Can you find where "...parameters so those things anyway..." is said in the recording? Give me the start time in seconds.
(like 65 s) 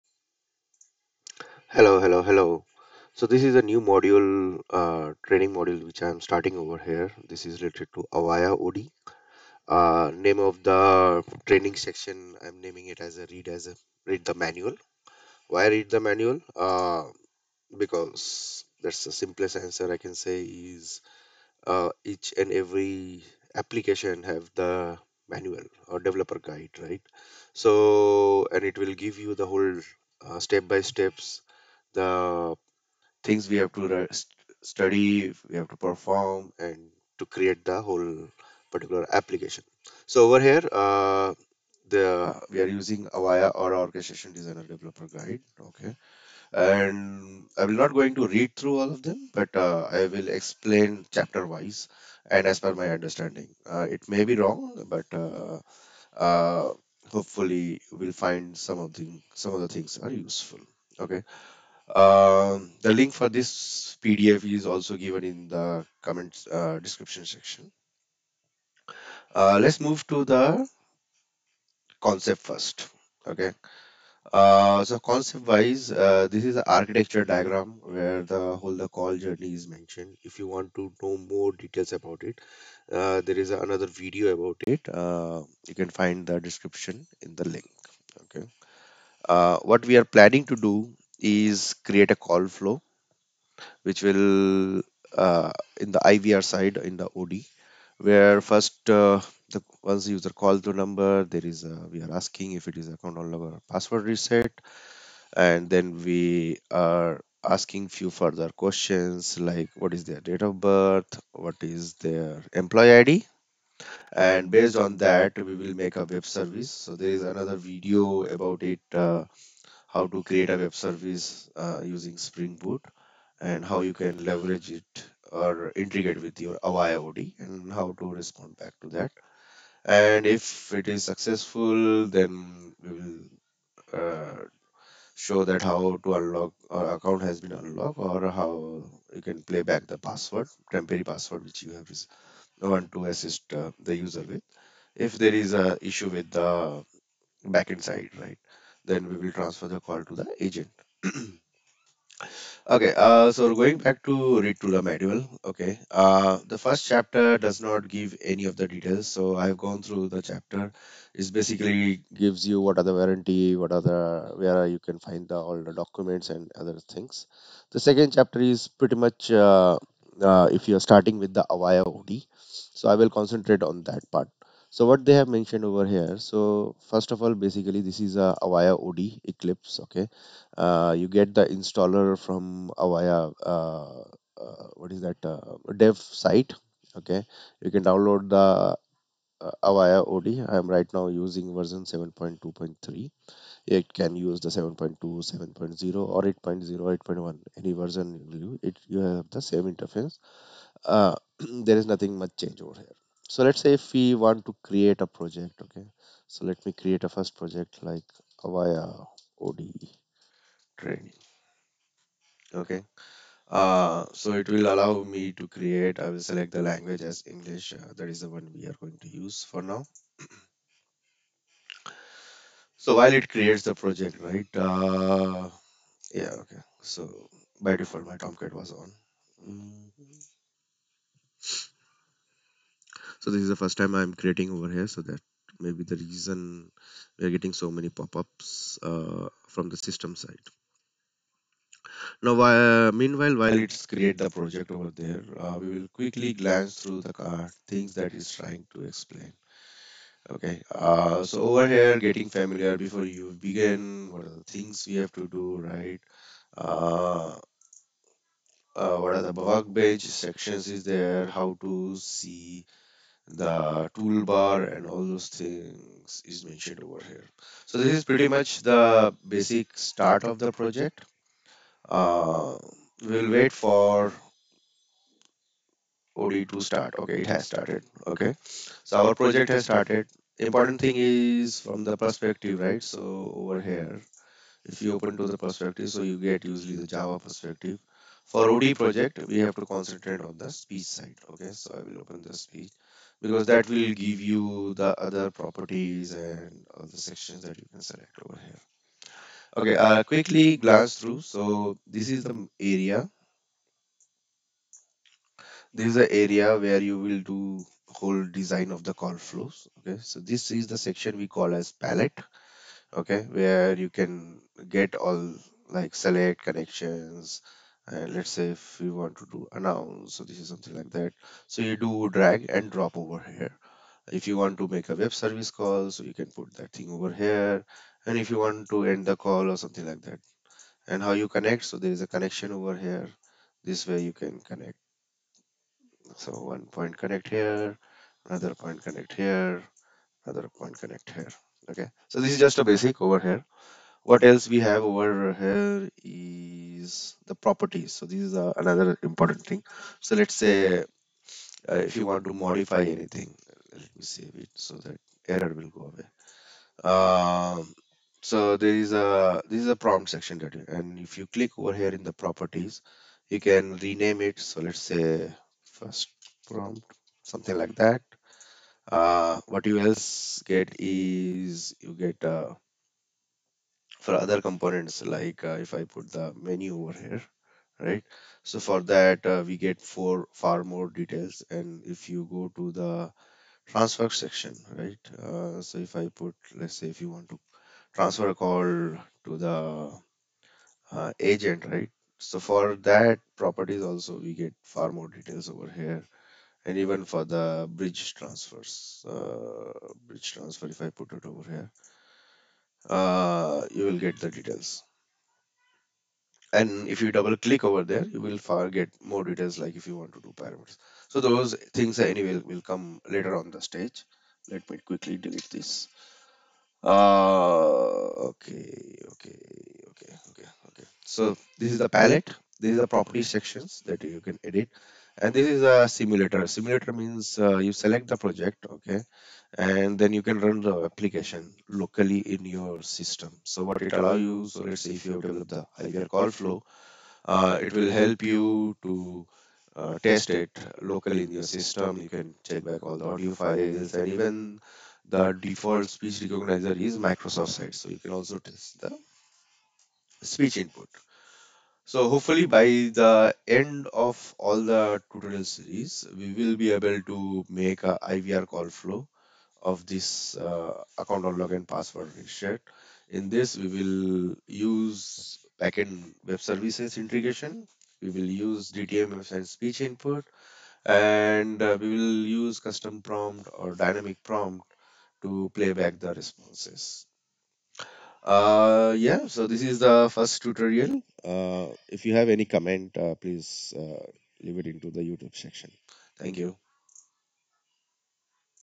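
410 s.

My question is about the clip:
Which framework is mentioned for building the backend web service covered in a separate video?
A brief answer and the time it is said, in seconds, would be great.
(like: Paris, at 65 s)
Spring Boot, at 122 s.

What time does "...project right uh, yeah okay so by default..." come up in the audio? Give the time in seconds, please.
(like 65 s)
223 s.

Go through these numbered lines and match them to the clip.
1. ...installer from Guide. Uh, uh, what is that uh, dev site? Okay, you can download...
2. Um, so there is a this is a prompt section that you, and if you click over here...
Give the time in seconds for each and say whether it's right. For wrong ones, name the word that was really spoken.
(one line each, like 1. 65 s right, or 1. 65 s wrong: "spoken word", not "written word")
1. 181 s wrong: "Avaya", not "Guide"
2. 356 s right.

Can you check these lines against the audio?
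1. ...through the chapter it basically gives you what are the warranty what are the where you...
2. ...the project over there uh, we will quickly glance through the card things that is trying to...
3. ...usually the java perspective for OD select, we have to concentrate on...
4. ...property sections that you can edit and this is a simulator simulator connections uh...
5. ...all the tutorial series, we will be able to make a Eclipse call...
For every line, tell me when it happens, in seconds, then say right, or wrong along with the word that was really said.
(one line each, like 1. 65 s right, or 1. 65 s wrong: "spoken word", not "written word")
1. 159 s right
2. 244 s right
3. 286 s wrong: "project", not "select"
4. 422 s wrong: "means", not "connections"
5. 454 s wrong: "IVR", not "Eclipse".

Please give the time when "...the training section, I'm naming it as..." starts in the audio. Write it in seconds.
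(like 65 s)
10 s.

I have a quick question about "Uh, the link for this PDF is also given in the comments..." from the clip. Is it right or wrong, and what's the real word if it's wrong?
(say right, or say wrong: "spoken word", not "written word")
right.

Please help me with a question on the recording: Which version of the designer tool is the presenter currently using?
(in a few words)
7.2.3.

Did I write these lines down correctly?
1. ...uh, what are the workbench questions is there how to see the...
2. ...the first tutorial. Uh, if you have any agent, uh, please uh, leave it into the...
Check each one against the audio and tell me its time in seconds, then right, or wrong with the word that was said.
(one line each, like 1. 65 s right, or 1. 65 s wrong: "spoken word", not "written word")
1. 258 s wrong: "sections", not "questions"
2. 479 s wrong: "comment", not "agent".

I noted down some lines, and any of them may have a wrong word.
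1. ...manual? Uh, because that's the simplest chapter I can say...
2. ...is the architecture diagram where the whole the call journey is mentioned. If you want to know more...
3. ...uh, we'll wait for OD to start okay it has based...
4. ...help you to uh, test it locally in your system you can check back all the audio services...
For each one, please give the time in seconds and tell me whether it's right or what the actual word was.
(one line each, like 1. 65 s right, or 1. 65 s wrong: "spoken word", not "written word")
1. 16 s wrong: "answer", not "chapter"
2. 76 s right
3. 271 s wrong: "started", not "based"
4. 437 s wrong: "files", not "services".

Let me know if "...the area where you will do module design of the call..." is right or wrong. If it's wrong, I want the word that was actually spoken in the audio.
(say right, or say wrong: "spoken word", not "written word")
wrong: "whole", not "module".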